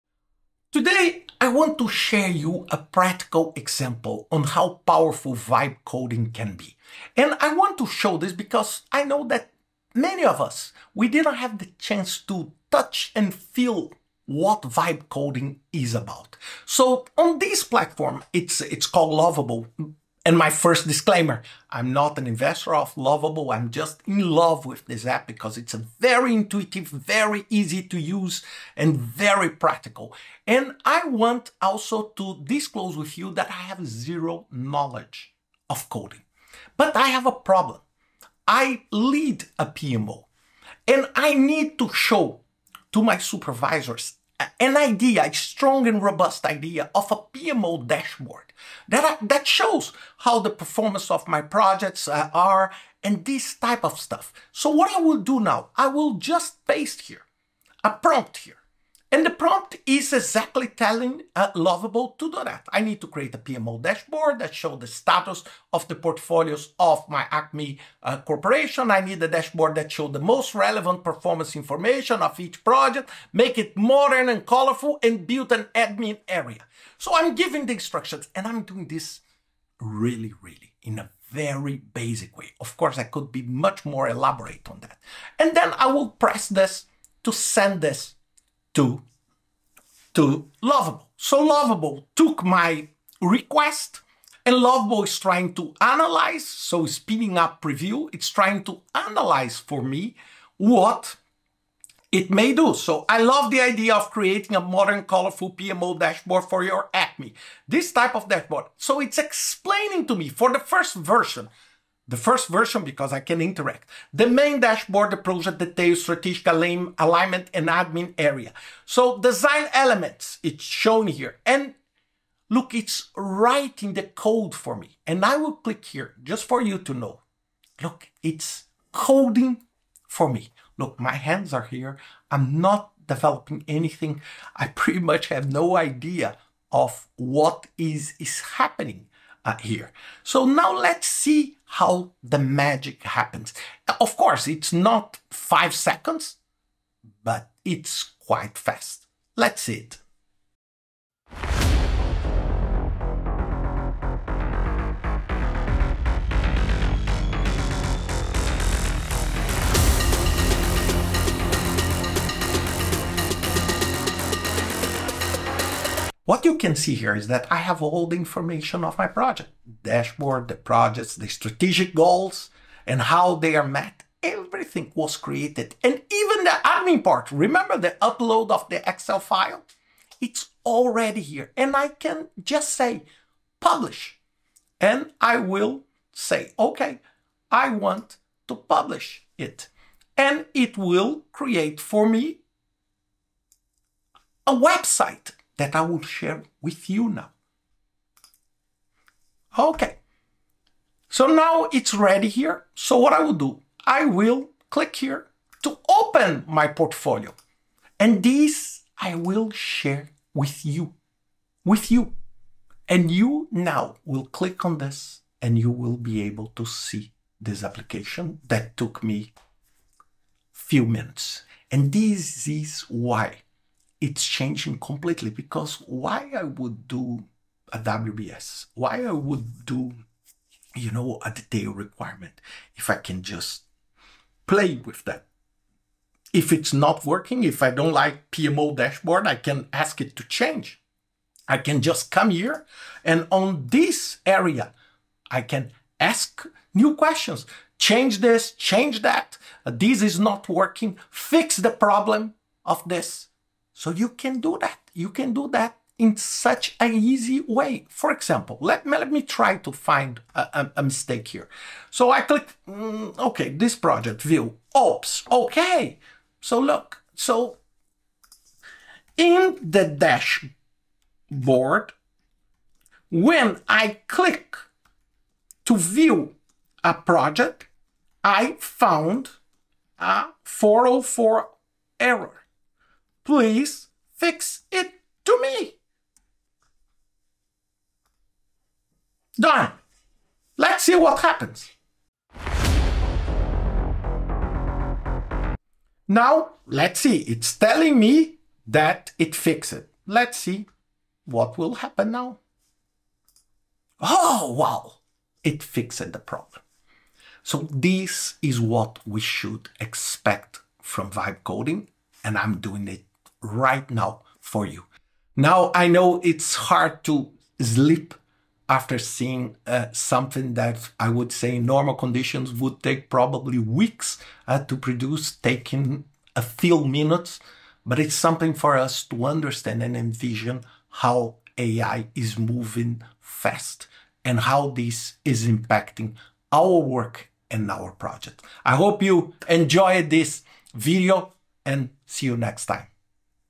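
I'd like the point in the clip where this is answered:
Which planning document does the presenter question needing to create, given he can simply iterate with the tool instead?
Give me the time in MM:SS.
03:47.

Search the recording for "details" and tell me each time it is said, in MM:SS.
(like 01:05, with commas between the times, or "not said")
01:55, 03:51.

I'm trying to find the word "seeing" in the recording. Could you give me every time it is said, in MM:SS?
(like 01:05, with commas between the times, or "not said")
05:18.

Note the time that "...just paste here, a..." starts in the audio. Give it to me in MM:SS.
00:56.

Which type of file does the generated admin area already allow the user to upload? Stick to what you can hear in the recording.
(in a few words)
Excel.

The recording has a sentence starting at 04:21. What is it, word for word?
So I click, mm, okay, this project view, oops, okay.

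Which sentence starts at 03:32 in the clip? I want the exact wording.
And you now will click on this and you will be able to see this application that took me few minutes.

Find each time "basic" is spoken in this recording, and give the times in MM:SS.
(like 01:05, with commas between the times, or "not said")
01:21.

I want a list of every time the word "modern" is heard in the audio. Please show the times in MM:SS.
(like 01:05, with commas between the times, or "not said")
01:13, 01:44.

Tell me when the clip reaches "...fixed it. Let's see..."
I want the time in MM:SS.
04:59.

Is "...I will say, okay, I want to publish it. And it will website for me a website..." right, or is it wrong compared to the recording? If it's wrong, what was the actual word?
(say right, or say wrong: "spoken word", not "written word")
wrong: "create", not "website".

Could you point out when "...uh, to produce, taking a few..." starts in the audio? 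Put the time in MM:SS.
05:24.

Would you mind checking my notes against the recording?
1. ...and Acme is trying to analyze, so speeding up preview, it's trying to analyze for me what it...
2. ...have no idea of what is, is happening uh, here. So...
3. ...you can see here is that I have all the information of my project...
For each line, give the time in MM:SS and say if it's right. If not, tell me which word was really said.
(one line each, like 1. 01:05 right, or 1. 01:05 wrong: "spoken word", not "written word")
1. 01:34 wrong: "Lovable", not "Acme"
2. 02:15 right
3. 02:46 right.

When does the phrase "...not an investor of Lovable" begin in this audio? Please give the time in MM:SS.
00:21.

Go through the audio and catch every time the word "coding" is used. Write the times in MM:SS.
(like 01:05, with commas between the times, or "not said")
00:05, 00:15, 00:35, 02:08, 05:11.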